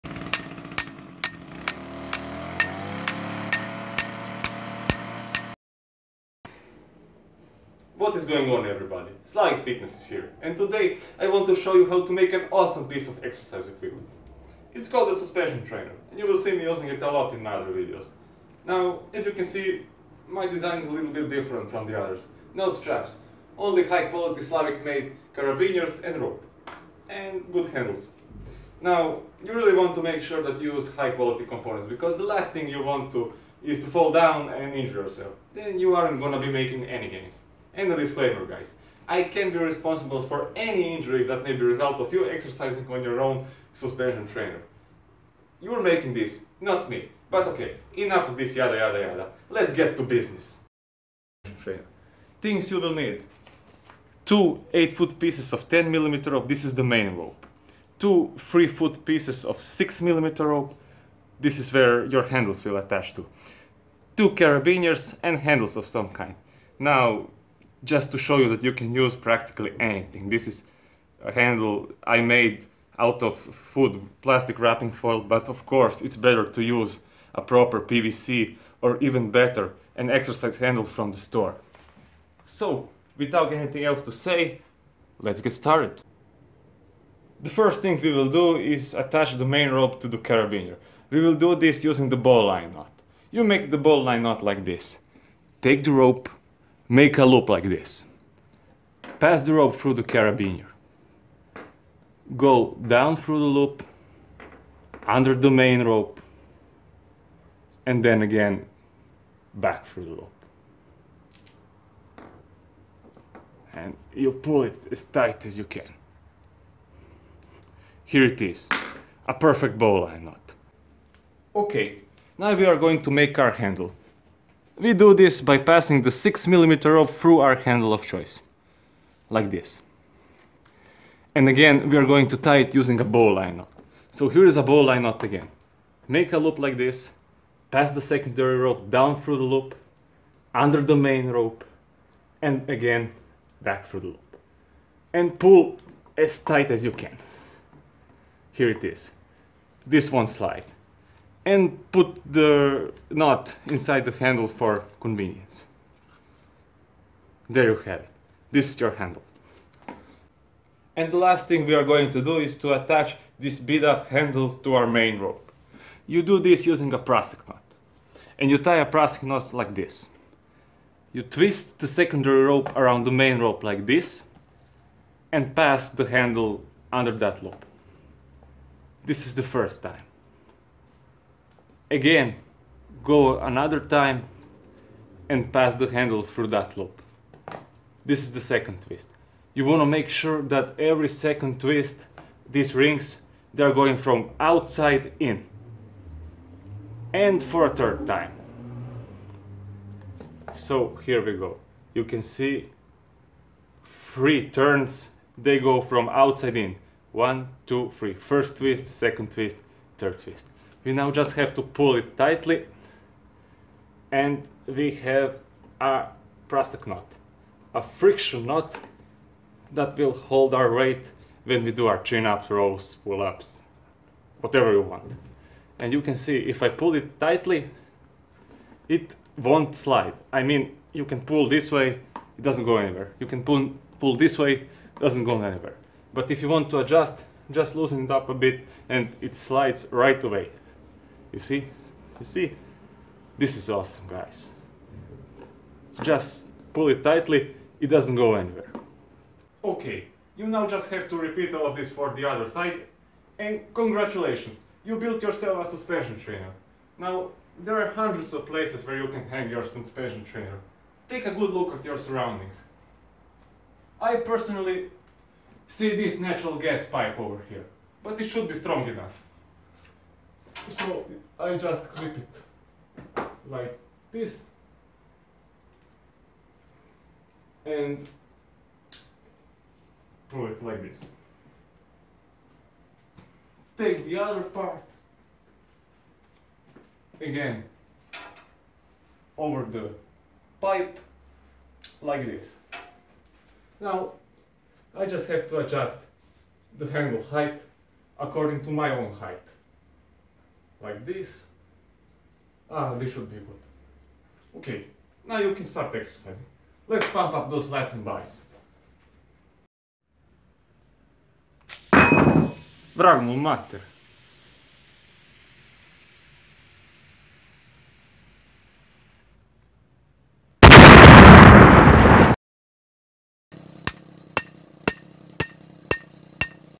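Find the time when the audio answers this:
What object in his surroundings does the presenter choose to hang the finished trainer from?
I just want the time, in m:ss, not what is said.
4:26.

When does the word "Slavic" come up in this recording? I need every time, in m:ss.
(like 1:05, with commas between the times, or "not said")
0:09, 0:24.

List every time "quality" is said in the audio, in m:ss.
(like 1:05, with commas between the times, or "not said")
0:24, 0:31.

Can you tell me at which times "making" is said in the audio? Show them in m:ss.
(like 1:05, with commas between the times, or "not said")
0:36, 0:45.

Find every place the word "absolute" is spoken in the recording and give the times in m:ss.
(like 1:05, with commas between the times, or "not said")
not said.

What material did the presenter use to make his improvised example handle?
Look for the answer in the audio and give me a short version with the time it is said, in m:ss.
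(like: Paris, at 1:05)
food plastic wrapping foil, at 1:13.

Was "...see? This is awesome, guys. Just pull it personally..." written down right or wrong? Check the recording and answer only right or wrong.
wrong.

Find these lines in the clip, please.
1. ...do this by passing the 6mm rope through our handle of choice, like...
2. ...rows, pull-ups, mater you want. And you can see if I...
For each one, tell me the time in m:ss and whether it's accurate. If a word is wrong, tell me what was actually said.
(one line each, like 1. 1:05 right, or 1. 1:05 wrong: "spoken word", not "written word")
1. 2:04 right
2. 3:42 wrong: "whatever", not "mater".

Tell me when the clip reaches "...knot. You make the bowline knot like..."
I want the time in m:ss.
1:32.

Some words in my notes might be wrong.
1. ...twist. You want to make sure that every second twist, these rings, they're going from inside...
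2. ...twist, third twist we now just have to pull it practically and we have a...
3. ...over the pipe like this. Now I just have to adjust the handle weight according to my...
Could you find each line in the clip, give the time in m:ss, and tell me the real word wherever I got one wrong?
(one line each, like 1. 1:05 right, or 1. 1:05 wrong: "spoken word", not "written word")
1. 3:08 wrong: "outside", not "inside"
2. 3:29 wrong: "tightly", not "practically"
3. 4:49 wrong: "height", not "weight".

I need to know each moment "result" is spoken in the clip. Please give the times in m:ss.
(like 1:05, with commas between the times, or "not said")
0:41.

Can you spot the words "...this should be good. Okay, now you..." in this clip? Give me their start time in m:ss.
5:02.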